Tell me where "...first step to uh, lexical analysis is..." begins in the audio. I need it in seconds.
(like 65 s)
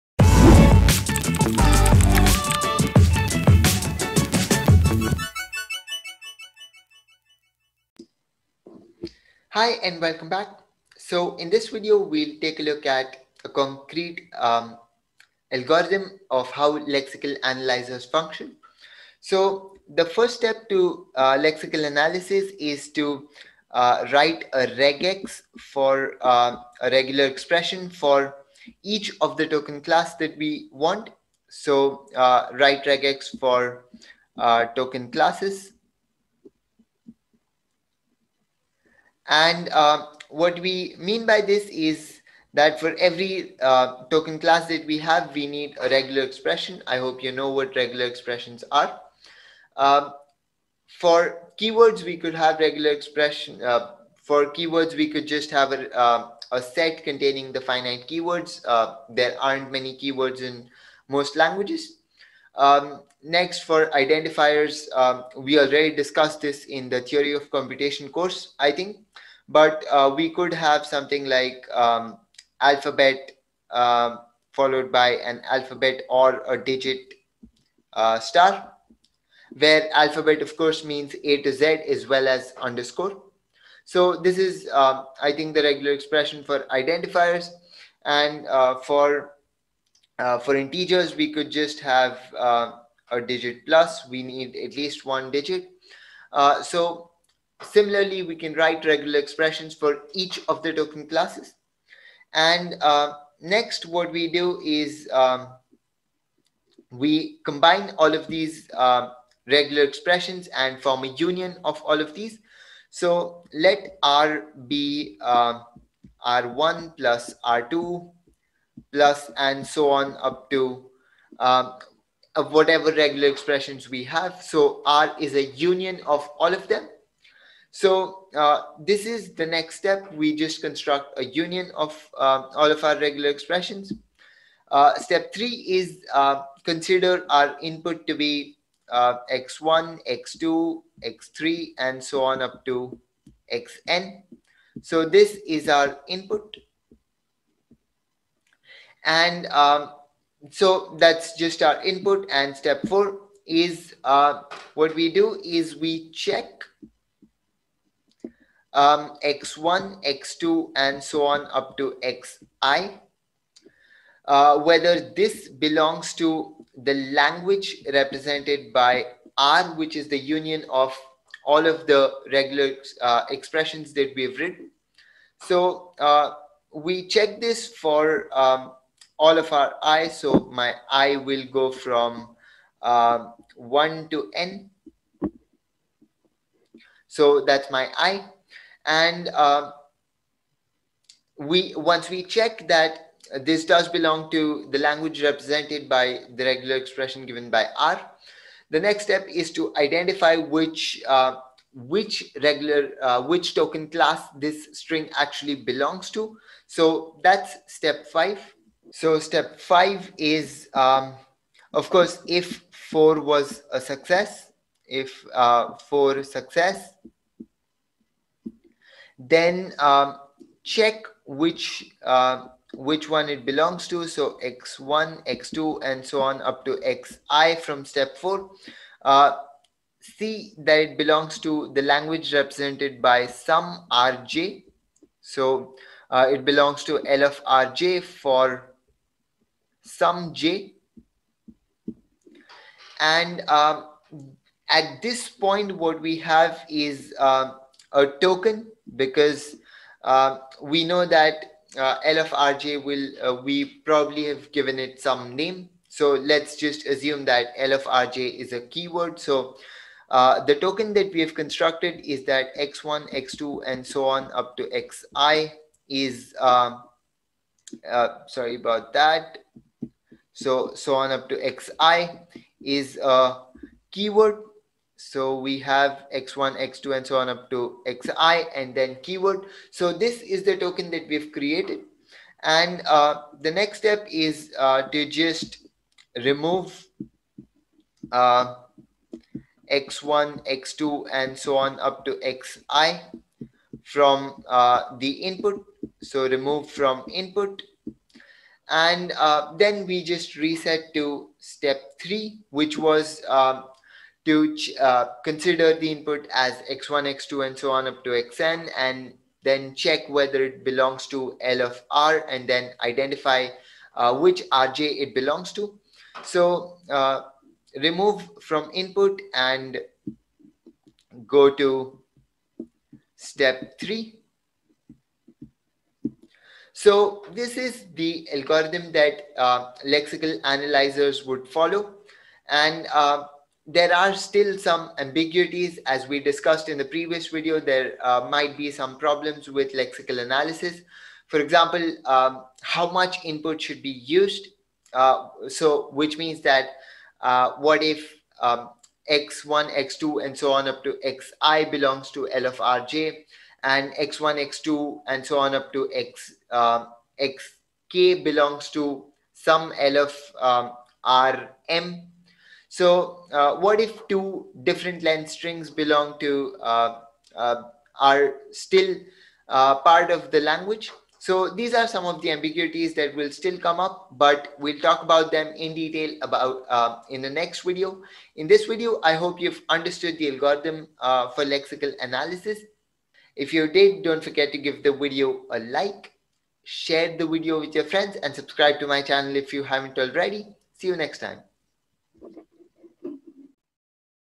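20 s.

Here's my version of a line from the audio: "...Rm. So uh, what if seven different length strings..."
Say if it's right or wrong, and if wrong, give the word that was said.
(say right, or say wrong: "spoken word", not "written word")
wrong: "two", not "seven".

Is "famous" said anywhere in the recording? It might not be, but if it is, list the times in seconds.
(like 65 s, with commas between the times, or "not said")
not said.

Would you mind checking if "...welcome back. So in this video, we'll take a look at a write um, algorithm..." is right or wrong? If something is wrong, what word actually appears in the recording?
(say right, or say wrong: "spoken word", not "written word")
wrong: "concrete", not "write".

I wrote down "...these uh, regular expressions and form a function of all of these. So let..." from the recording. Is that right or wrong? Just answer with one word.
wrong.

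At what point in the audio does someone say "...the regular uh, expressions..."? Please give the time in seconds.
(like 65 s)
171 s.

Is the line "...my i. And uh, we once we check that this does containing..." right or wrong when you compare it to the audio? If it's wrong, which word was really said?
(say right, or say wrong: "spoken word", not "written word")
wrong: "belong", not "containing".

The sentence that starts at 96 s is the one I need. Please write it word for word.
Uh, so similarly, we can write regular expressions for each of the token classes.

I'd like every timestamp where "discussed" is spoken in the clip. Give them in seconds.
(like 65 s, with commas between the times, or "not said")
65 s, 336 s.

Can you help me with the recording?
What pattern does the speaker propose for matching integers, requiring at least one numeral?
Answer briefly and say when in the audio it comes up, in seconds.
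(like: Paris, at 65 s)
digit plus, at 93 s.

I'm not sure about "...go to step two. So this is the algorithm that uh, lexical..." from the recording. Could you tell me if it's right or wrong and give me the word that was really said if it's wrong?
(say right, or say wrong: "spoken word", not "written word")
wrong: "three", not "two".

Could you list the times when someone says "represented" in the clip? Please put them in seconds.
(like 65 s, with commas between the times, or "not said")
167 s, 195 s, 232 s.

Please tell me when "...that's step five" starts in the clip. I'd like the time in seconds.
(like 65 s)
207 s.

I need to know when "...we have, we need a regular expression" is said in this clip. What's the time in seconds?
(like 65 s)
44 s.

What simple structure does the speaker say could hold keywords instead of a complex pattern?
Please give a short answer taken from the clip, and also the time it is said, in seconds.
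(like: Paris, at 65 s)
A set, at 56 s.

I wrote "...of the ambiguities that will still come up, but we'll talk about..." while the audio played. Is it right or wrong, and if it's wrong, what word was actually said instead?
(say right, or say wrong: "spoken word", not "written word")
right.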